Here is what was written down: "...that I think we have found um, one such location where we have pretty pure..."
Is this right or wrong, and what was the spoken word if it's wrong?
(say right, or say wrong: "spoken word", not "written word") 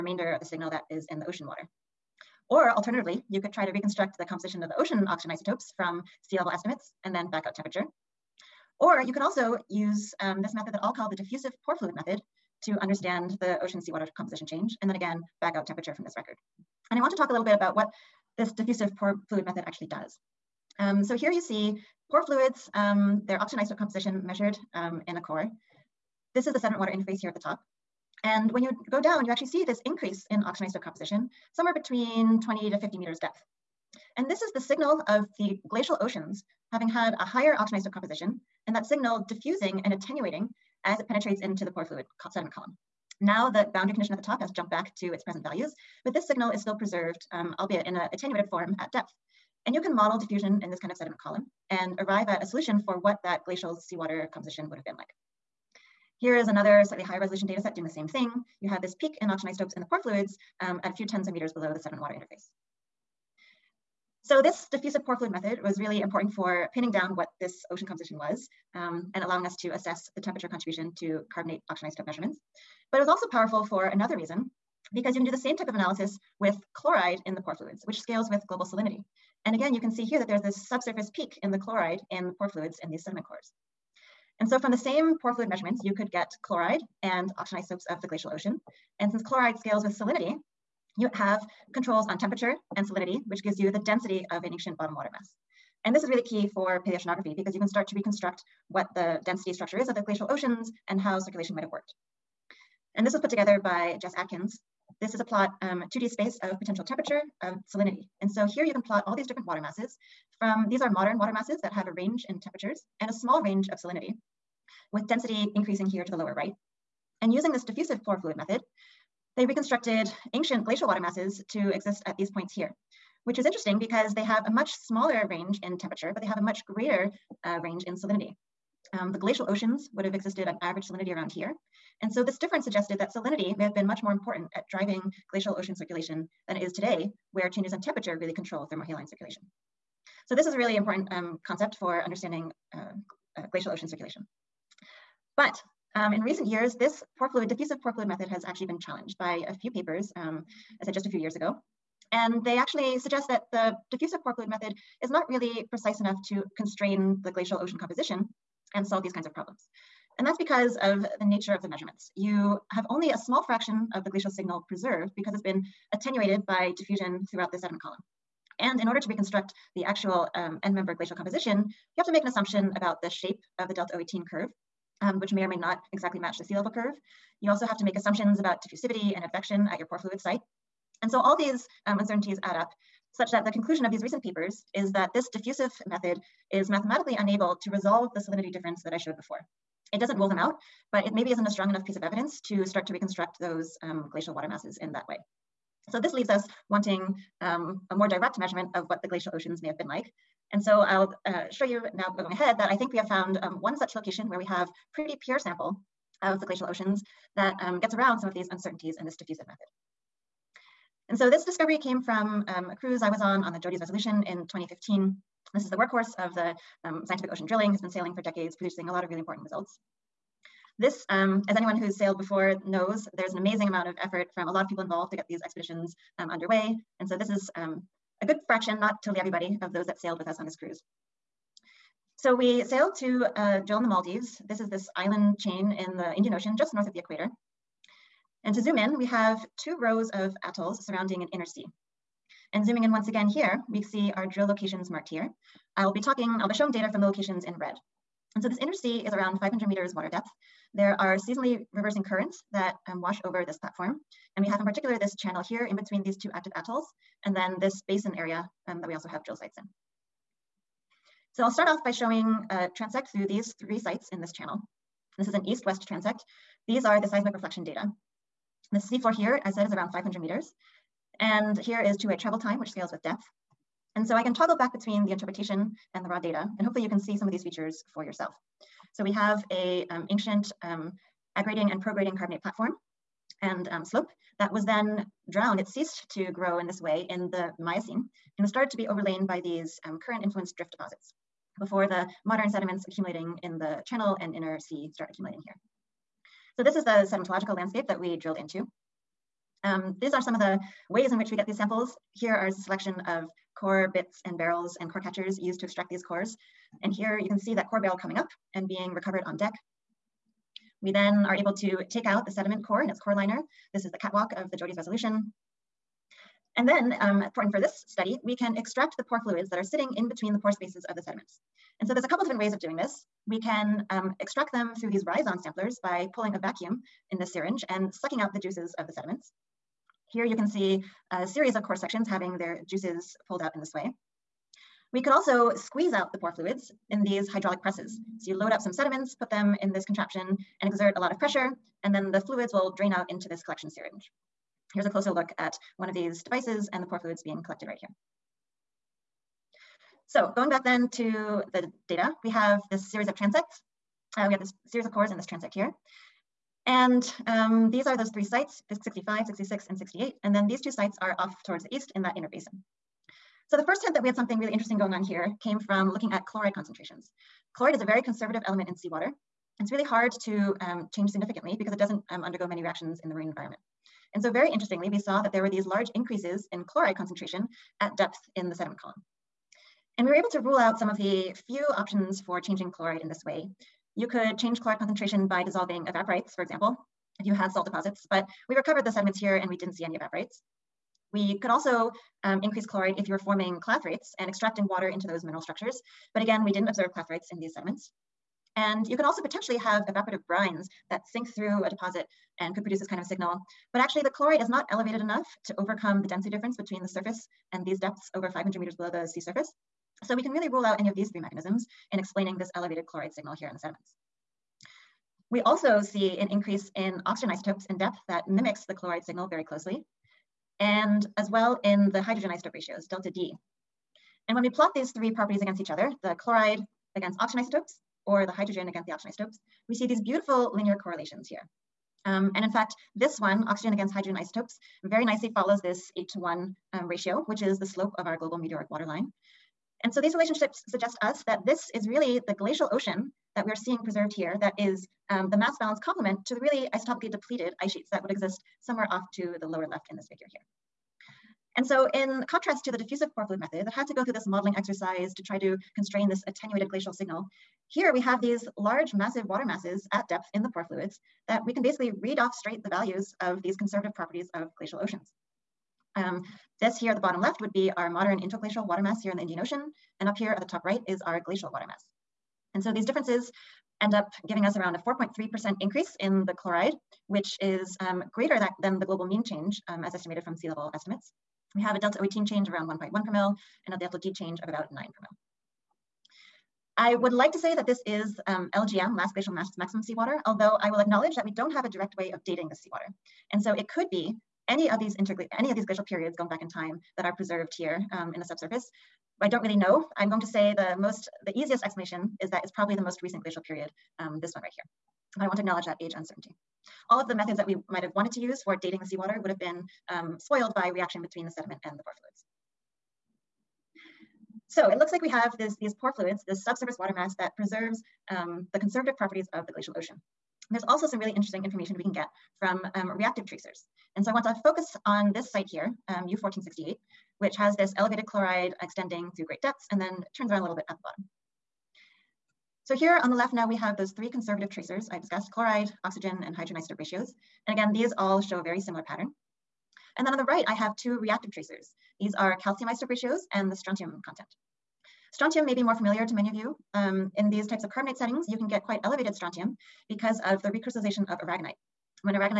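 right.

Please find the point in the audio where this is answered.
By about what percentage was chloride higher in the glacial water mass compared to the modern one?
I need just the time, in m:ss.
7:54.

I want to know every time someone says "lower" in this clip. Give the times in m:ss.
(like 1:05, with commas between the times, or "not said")
1:56, 7:29.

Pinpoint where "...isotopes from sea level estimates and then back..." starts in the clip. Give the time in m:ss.
0:05.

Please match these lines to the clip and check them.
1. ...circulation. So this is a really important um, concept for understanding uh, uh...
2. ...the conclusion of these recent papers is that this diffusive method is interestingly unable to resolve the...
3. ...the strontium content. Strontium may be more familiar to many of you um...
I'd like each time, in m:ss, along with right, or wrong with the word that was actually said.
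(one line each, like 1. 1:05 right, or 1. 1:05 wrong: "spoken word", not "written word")
1. 2:19 right
2. 3:03 wrong: "mathematically", not "interestingly"
3. 9:03 right.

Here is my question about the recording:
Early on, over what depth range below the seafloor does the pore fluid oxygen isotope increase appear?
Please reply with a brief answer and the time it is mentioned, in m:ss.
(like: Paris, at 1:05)
20 to 50 meters, at 0:32.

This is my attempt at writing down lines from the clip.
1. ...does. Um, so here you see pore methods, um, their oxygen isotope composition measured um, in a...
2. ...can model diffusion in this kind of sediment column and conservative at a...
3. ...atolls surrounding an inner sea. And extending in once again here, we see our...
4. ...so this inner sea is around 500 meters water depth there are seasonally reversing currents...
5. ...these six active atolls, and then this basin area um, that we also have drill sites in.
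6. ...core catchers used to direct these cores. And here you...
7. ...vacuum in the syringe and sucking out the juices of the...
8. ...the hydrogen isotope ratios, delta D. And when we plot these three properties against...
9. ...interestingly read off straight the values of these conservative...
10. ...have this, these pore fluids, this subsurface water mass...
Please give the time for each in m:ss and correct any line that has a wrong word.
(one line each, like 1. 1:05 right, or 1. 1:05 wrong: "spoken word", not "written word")
1. 0:19 wrong: "fluids", not "methods"
2. 0:49 wrong: "arrive", not "conservative"
3. 4:00 wrong: "zooming", not "extending"
4. 4:08 right
5. 4:16 wrong: "two", not "six"
6. 5:04 wrong: "extract", not "direct"
7. 5:26 right
8. 7:01 right
9. 7:41 wrong: "basically", not "interestingly"
10. 8:35 right.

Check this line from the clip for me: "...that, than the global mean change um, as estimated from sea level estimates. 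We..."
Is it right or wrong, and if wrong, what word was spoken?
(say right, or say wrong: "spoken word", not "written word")
right.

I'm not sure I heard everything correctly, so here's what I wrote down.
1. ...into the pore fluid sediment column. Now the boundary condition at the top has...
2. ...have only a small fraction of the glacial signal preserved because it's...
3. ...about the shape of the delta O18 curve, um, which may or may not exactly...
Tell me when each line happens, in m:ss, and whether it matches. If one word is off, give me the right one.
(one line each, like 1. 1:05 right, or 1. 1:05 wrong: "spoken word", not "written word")
1. 0:41 right
2. 2:42 right
3. 2:52 right.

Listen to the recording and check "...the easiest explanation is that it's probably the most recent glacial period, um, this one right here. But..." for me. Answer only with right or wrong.
right.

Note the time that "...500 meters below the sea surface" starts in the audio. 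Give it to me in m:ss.
6:48.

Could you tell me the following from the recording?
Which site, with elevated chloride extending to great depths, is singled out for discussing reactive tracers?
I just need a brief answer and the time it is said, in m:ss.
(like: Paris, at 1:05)
U1468, at 8:46.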